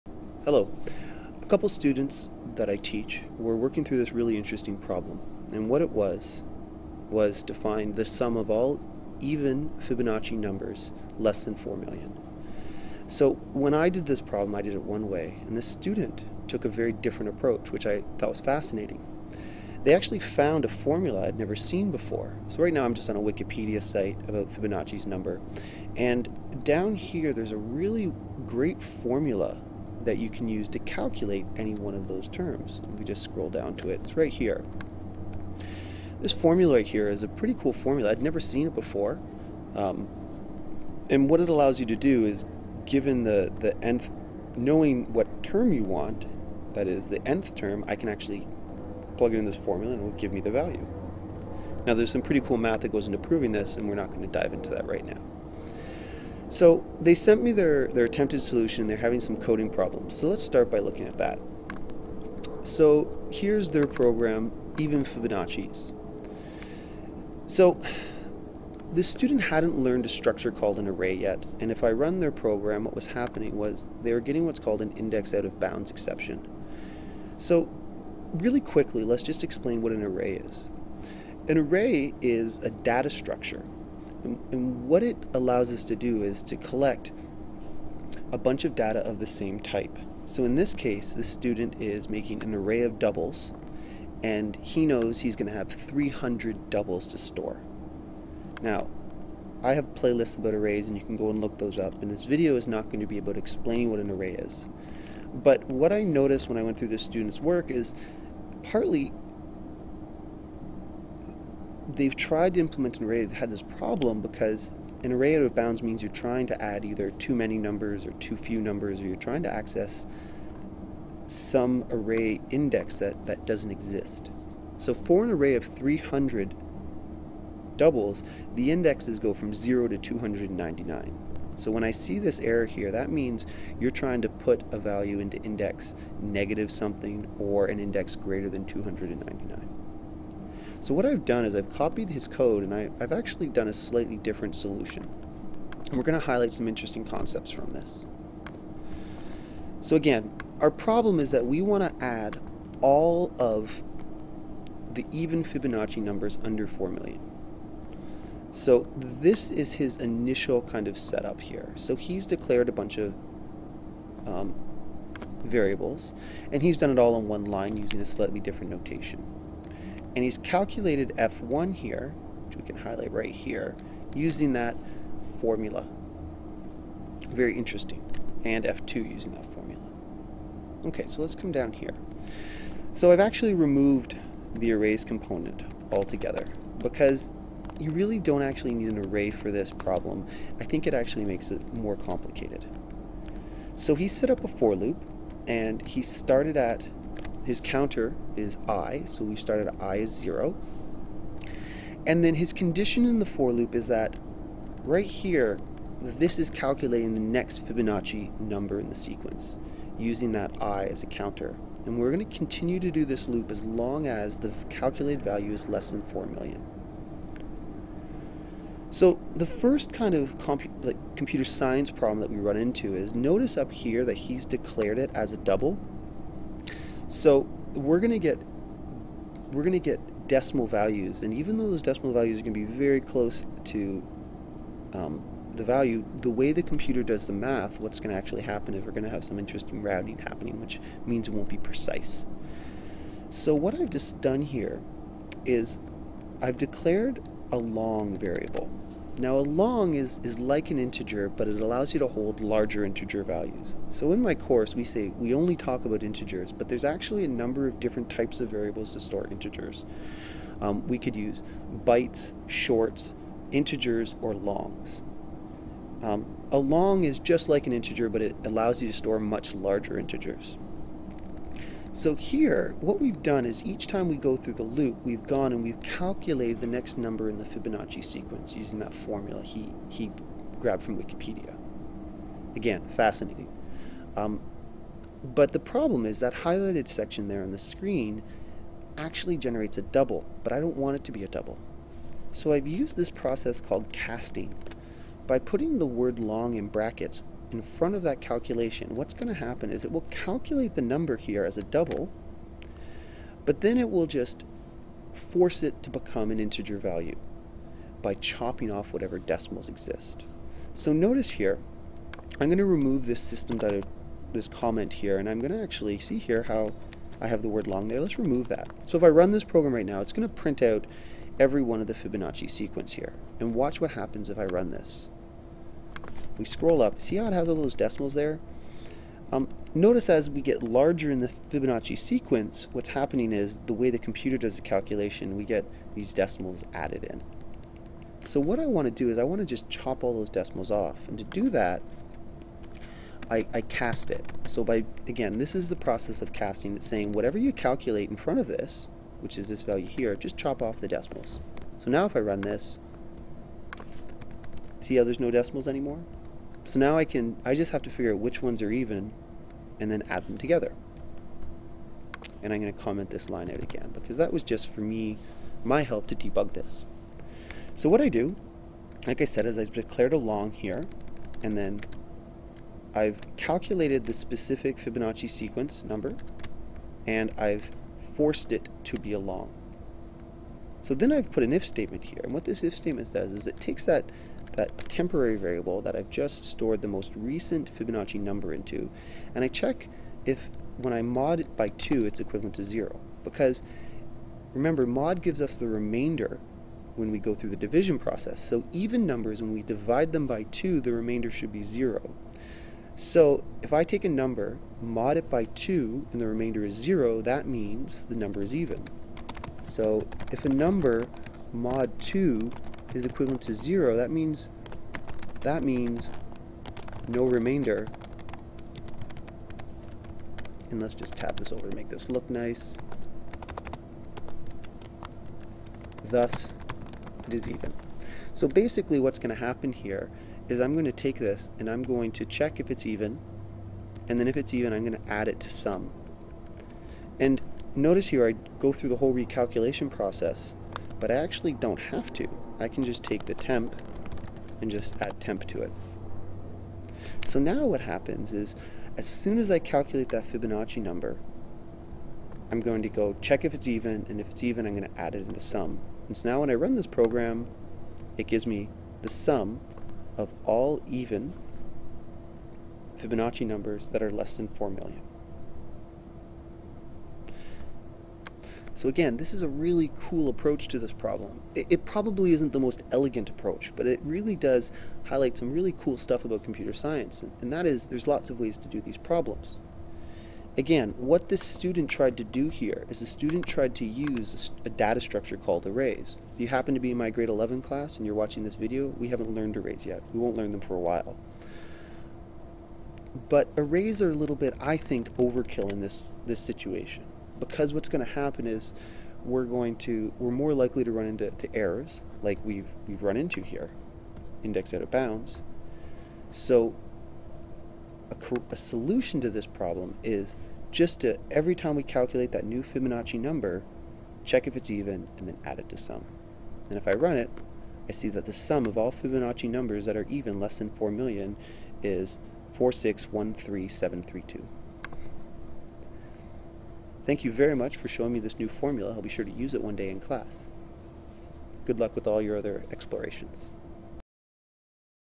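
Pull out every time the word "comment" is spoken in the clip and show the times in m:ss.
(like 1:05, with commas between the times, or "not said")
5:14, 6:02.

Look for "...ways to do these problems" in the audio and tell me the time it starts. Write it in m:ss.
7:58.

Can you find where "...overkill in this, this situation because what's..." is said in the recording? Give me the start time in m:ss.
8:15.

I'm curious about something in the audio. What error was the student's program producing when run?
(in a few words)
Index out of bounds exception.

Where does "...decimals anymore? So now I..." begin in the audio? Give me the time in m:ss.
5:55.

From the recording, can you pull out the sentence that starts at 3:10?
I think it actually makes it more complicated.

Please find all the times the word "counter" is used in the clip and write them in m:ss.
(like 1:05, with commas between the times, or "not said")
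3:17, 3:31.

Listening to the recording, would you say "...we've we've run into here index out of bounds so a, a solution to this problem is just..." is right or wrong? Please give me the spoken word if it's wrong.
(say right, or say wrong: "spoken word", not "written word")
right.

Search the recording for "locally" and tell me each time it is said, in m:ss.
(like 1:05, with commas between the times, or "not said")
not said.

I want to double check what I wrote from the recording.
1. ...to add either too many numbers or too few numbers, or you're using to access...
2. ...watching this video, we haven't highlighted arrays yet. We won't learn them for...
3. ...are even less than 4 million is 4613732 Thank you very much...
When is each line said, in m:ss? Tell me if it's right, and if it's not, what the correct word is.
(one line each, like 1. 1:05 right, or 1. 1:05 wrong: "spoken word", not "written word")
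1. 1:56 wrong: "trying", not "using"
2. 8:08 wrong: "learned", not "highlighted"
3. 8:39 right.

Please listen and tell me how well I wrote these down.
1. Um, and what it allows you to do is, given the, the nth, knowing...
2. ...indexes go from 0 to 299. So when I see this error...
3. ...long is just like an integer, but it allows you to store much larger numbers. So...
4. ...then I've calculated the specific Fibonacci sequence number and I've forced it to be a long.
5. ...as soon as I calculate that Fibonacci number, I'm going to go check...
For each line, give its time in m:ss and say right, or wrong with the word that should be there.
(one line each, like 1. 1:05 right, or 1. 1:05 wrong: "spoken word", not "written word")
1. 0:39 right
2. 2:08 right
3. 4:26 wrong: "integers", not "numbers"
4. 6:11 right
5. 7:28 right.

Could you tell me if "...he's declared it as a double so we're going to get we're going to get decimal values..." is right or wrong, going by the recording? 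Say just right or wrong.
right.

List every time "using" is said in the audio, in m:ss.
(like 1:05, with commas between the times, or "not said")
2:47, 2:54, 2:59, 3:29, 4:38.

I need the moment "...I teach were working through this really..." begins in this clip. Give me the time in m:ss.
0:02.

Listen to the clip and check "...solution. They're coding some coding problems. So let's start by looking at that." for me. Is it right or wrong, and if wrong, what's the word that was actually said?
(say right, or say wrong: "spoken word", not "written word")
wrong: "having", not "coding".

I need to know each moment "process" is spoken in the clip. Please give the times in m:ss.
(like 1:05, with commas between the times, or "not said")
4:53, 5:45, 6:37, 7:19.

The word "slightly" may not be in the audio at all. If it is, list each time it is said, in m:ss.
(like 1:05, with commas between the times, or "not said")
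2:23, 2:48.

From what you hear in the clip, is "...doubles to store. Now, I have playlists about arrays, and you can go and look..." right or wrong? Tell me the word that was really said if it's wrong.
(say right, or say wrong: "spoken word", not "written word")
right.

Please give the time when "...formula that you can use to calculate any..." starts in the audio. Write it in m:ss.
0:28.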